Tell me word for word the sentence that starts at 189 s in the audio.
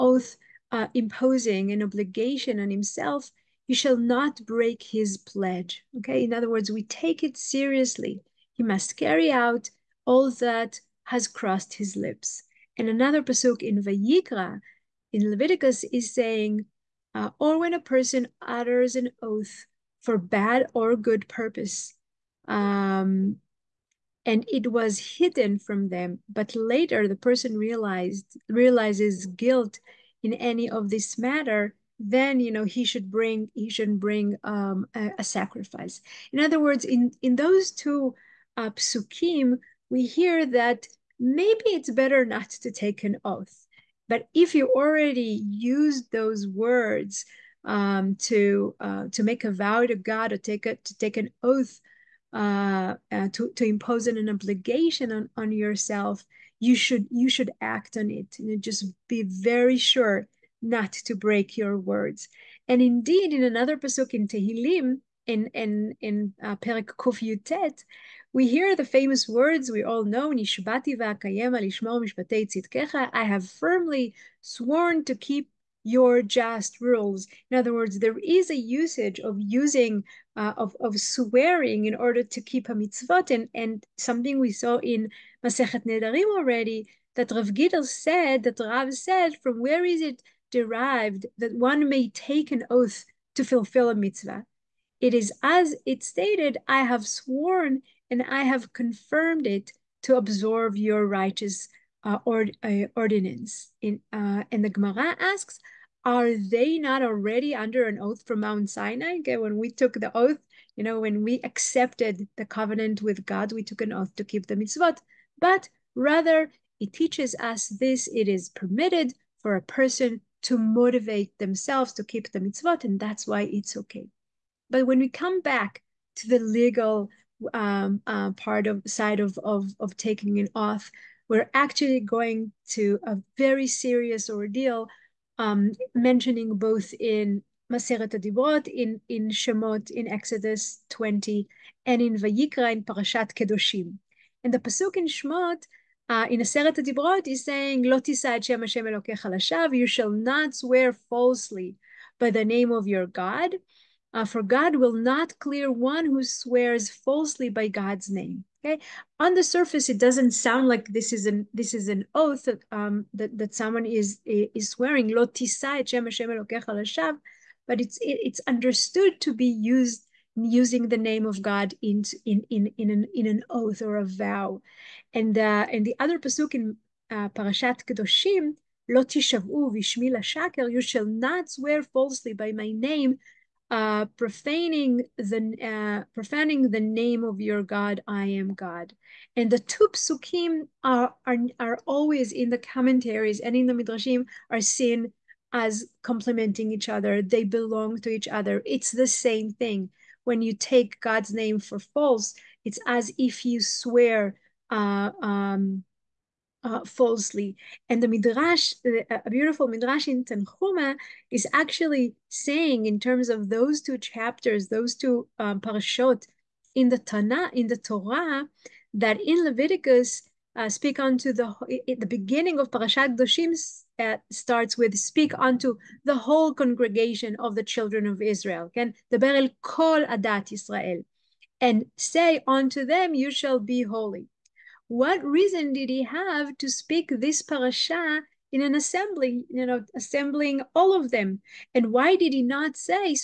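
And the two psukim are, are, are always in the commentaries and in the midrashim are seen as complementing each other.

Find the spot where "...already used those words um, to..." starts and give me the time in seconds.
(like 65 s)
44 s.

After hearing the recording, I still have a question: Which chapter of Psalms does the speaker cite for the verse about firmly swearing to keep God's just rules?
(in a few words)
Perek Kuf Yud Tet (119).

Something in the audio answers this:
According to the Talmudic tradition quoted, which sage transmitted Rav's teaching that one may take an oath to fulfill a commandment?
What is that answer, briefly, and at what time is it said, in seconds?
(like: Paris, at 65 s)
Rav Gidel, at 87 s.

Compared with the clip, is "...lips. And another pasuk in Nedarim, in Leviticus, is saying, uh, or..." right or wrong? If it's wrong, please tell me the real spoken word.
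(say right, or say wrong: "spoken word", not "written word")
wrong: "Vayikra", not "Nedarim".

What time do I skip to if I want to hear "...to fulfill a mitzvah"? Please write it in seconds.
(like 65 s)
93 s.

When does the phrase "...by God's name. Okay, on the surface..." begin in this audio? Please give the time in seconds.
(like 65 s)
157 s.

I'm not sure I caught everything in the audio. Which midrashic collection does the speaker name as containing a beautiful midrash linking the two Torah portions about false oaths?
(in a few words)
Tanhuma.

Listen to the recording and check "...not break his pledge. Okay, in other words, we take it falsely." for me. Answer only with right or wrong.
wrong.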